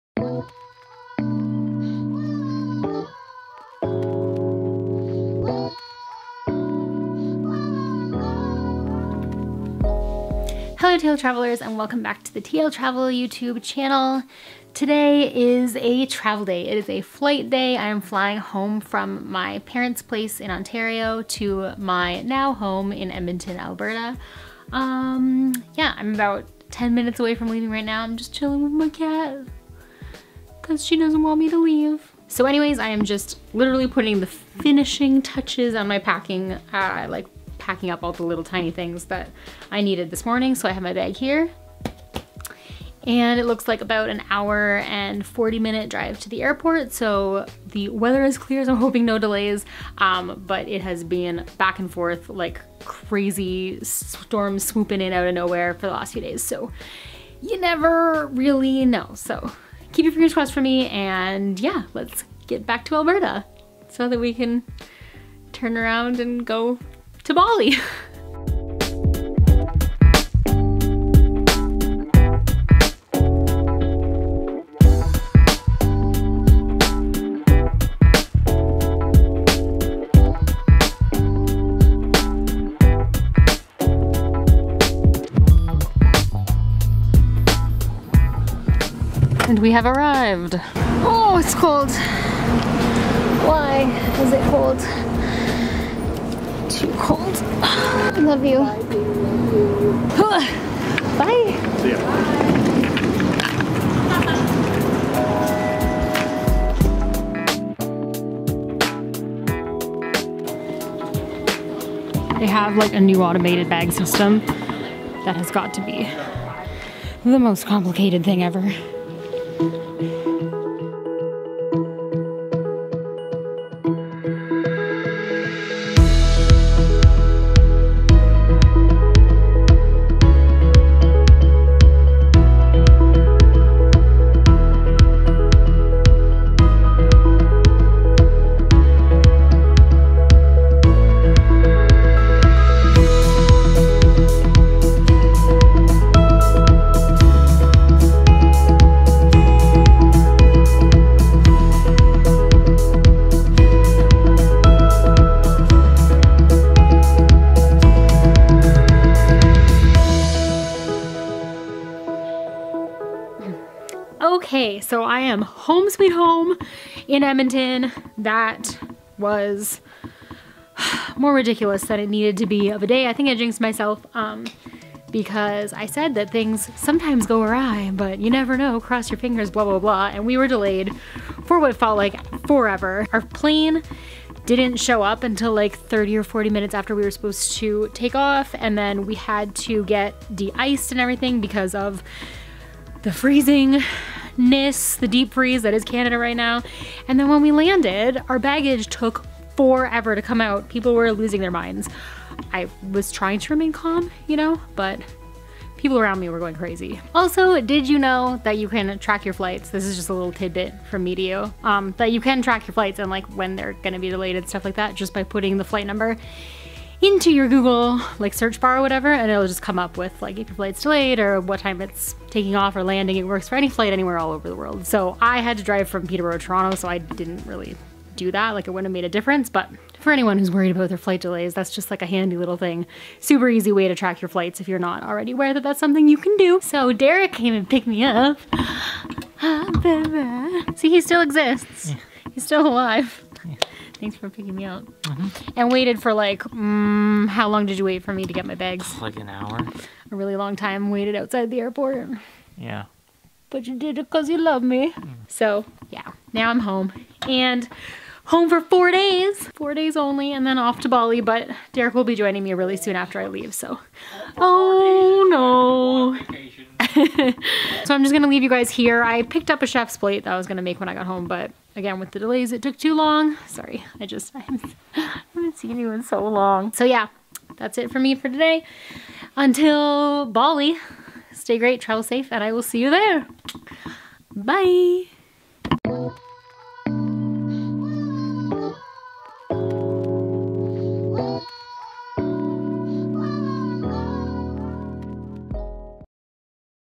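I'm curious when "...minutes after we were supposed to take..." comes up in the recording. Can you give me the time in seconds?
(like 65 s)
186 s.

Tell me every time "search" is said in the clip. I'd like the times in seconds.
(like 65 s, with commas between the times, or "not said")
218 s.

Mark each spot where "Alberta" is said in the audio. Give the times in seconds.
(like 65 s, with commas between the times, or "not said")
23 s, 62 s.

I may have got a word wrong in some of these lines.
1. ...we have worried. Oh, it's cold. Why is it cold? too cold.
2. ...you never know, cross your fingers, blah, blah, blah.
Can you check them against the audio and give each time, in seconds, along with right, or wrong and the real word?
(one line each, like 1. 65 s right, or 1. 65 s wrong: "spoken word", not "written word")
1. 89 s wrong: "arrived", not "worried"
2. 178 s right.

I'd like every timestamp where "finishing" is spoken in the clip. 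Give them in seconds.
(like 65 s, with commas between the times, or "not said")
34 s.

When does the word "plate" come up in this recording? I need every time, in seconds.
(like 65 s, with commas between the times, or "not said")
269 s.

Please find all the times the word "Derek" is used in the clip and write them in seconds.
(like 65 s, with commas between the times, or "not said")
236 s, 261 s.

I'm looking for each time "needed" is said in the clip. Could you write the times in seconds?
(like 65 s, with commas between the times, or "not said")
39 s, 172 s.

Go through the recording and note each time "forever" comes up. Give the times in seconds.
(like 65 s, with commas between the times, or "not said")
182 s, 199 s.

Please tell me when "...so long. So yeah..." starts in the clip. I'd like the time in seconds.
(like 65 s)
276 s.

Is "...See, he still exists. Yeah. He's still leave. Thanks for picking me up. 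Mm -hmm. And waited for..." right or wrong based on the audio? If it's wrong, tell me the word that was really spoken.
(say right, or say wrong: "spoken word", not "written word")
wrong: "alive", not "leave".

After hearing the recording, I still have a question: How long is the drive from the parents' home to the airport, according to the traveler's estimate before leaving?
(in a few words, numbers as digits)
1 hour 40 minutes.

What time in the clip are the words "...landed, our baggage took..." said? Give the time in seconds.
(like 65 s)
197 s.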